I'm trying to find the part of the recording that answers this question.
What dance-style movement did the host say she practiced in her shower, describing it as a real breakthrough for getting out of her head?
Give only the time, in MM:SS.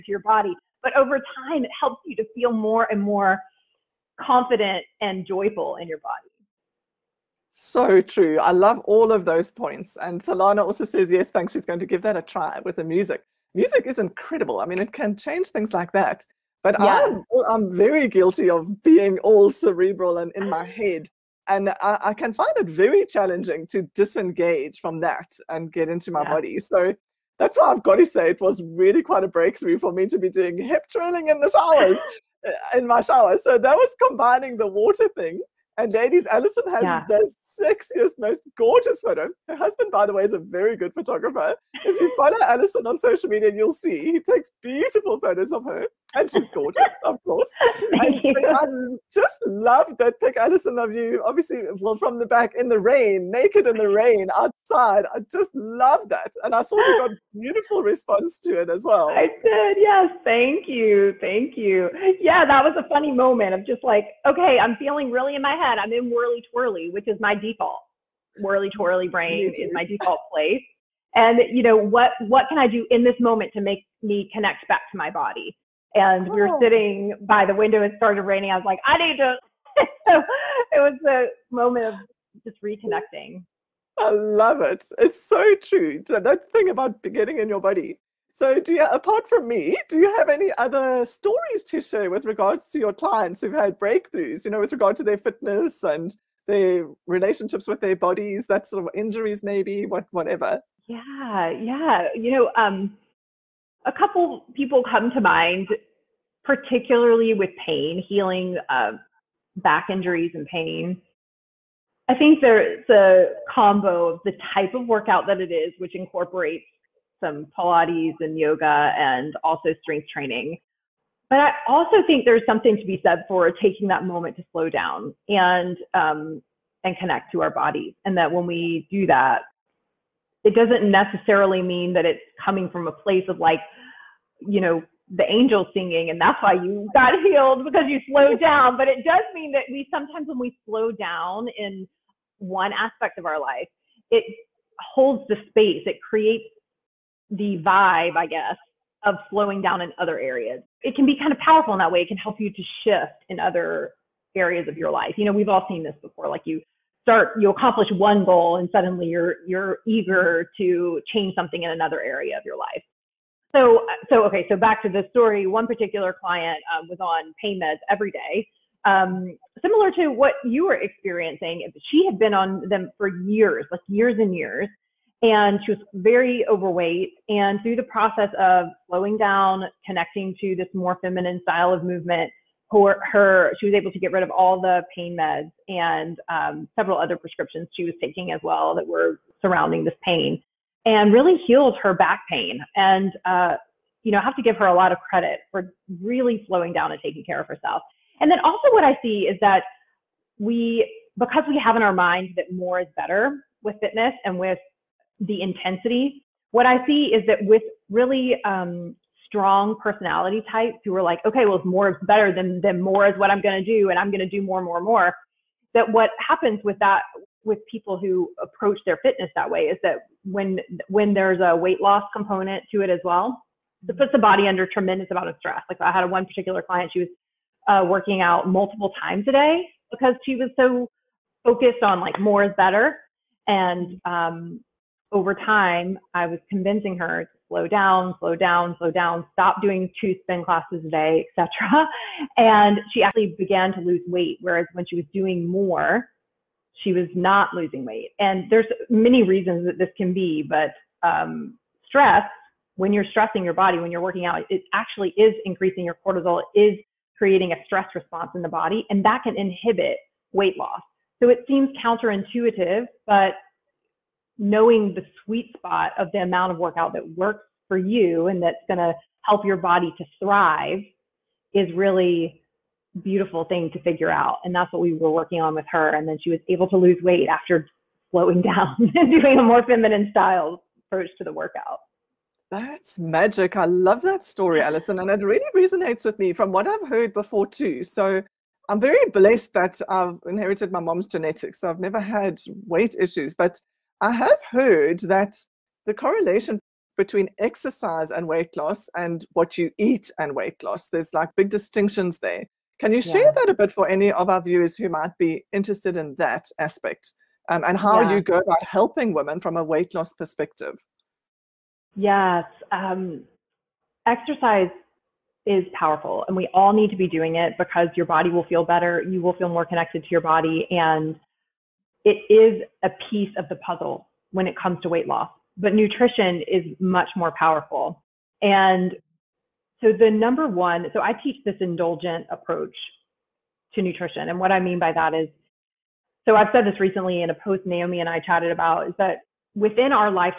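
00:30.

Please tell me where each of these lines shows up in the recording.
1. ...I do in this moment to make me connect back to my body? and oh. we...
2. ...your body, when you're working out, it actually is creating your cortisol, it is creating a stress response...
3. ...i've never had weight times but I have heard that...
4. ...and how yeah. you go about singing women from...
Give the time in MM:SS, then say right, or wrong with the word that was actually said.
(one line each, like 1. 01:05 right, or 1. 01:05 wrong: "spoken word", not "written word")
1. 01:12 right
2. 04:13 wrong: "increasing", not "creating"
3. 04:51 wrong: "issues", not "times"
4. 05:07 wrong: "helping", not "singing".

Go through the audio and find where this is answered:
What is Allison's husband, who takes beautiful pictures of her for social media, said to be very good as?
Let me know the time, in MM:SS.
00:40.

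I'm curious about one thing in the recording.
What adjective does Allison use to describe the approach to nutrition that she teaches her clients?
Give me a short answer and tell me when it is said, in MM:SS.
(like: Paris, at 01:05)
indulgent, at 05:31.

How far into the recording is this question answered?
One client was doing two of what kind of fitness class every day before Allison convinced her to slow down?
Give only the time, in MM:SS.
04:00.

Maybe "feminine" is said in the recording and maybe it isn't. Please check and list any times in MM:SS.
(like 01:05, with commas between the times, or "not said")
03:00, 04:39.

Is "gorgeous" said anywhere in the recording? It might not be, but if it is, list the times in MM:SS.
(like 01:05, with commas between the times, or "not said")
00:38, 00:46.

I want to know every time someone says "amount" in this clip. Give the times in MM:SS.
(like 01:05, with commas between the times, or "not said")
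03:45, 04:26.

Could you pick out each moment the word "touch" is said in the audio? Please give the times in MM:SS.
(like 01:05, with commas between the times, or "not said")
not said.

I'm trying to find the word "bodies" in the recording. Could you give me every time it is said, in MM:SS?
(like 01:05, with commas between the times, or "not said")
01:37, 02:07.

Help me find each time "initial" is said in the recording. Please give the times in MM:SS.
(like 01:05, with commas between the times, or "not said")
not said.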